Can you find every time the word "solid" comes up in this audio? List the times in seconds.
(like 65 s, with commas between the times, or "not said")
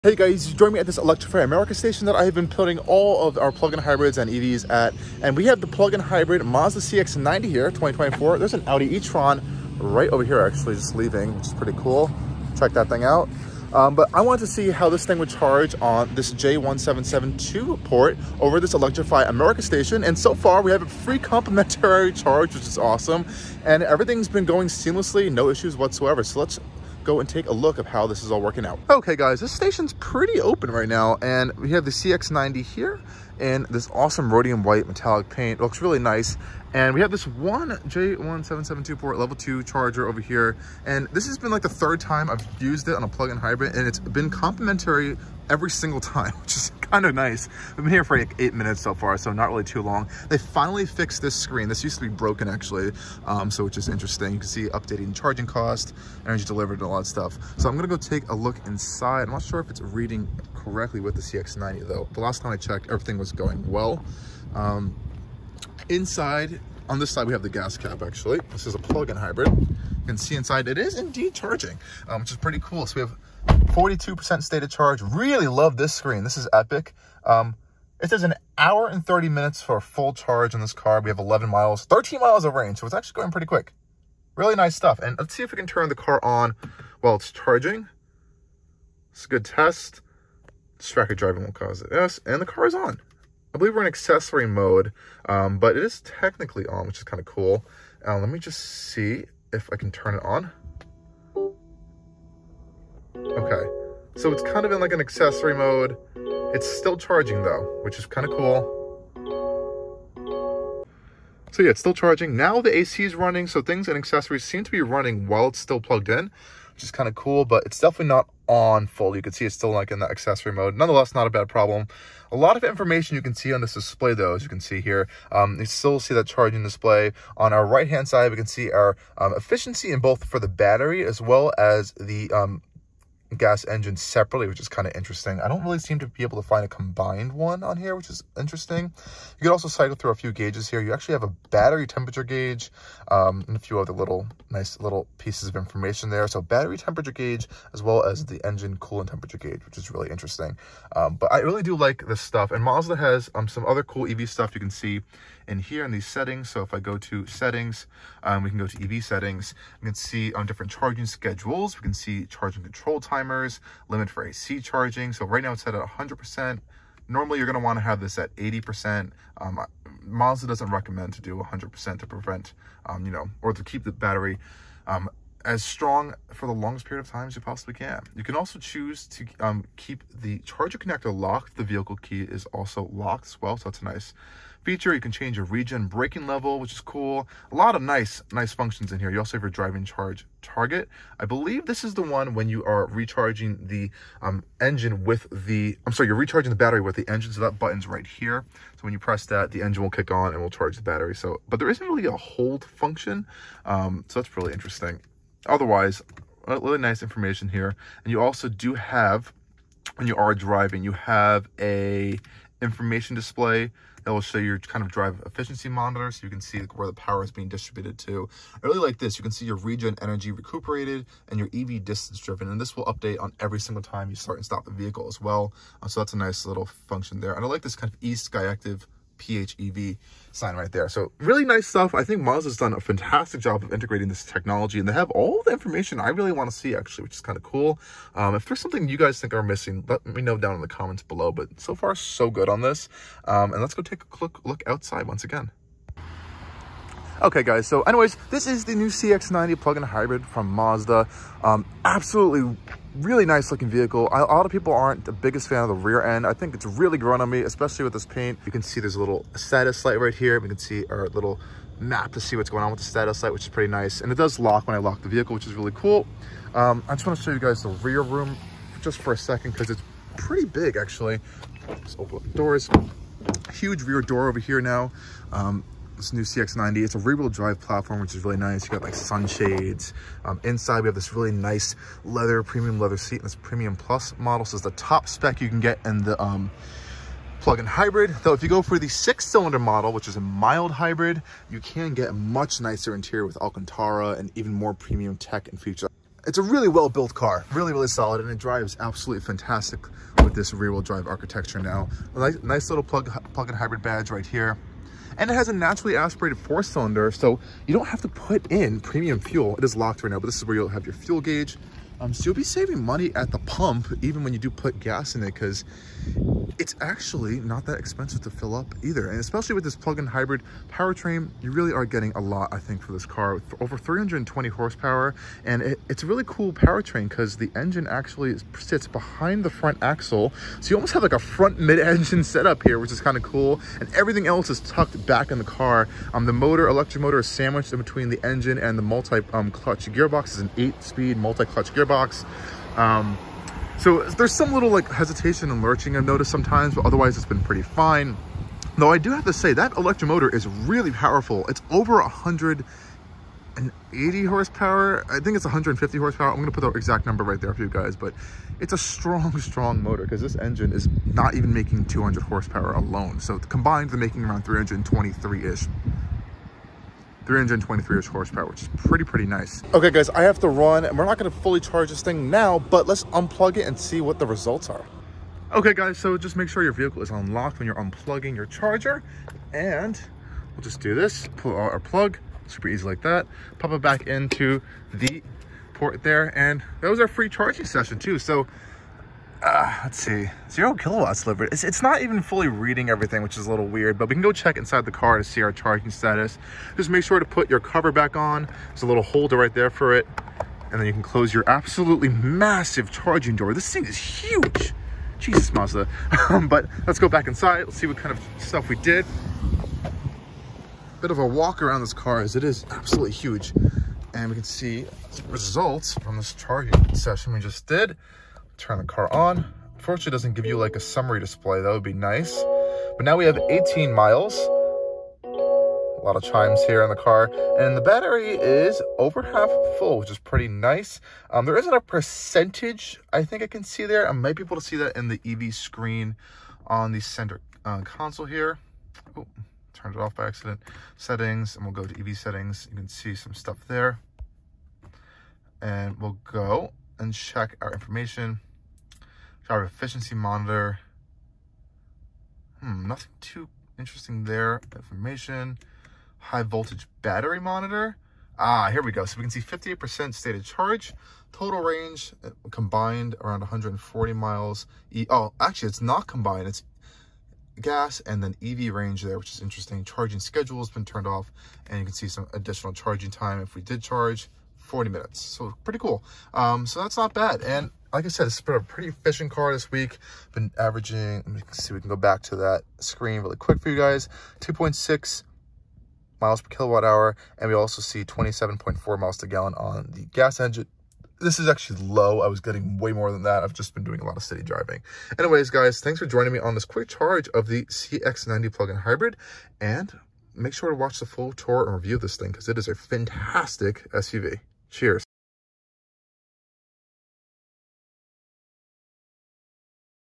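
297 s.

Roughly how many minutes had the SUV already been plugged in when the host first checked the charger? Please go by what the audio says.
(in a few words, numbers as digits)
8.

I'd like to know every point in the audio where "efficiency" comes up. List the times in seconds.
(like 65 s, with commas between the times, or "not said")
129 s, 215 s, 449 s.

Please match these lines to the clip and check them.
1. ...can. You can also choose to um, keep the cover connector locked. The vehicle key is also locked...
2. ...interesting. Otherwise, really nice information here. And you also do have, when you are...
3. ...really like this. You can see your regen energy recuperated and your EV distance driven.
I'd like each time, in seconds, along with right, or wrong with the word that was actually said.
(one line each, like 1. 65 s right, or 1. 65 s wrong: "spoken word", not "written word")
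1. 177 s wrong: "charger", not "cover"
2. 204 s right
3. 218 s right.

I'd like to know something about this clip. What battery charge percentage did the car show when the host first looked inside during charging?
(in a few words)
42%.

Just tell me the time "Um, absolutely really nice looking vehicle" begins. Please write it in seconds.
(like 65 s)
251 s.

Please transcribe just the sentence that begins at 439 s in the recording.
Oh, turned it off by accident.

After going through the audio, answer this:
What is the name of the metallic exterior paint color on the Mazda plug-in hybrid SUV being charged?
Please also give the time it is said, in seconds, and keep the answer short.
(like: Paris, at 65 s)
rhodium white metallic, at 34 s.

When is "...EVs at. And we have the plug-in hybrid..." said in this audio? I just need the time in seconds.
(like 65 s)
4 s.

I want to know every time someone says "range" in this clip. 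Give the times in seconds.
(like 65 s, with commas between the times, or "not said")
82 s, 461 s, 468 s.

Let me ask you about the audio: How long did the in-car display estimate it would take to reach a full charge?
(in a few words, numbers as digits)
an hour and 30 minutes.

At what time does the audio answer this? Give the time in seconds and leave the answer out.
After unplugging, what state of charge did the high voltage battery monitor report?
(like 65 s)
459 s.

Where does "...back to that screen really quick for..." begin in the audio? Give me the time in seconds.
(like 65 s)
481 s.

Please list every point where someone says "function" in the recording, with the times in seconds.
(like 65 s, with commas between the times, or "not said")
188 s, 202 s, 226 s.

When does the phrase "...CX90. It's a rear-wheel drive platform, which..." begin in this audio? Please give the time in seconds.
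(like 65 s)
276 s.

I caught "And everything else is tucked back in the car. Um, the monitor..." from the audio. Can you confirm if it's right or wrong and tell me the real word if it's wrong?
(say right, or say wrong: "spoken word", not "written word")
wrong: "motor", not "monitor".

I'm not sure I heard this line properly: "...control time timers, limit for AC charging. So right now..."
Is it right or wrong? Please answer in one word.
right.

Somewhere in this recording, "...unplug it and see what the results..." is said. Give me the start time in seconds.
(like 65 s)
373 s.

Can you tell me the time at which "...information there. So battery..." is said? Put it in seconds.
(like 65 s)
145 s.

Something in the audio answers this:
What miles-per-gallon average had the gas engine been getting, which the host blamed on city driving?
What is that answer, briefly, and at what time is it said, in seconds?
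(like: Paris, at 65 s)
27.4, at 488 s.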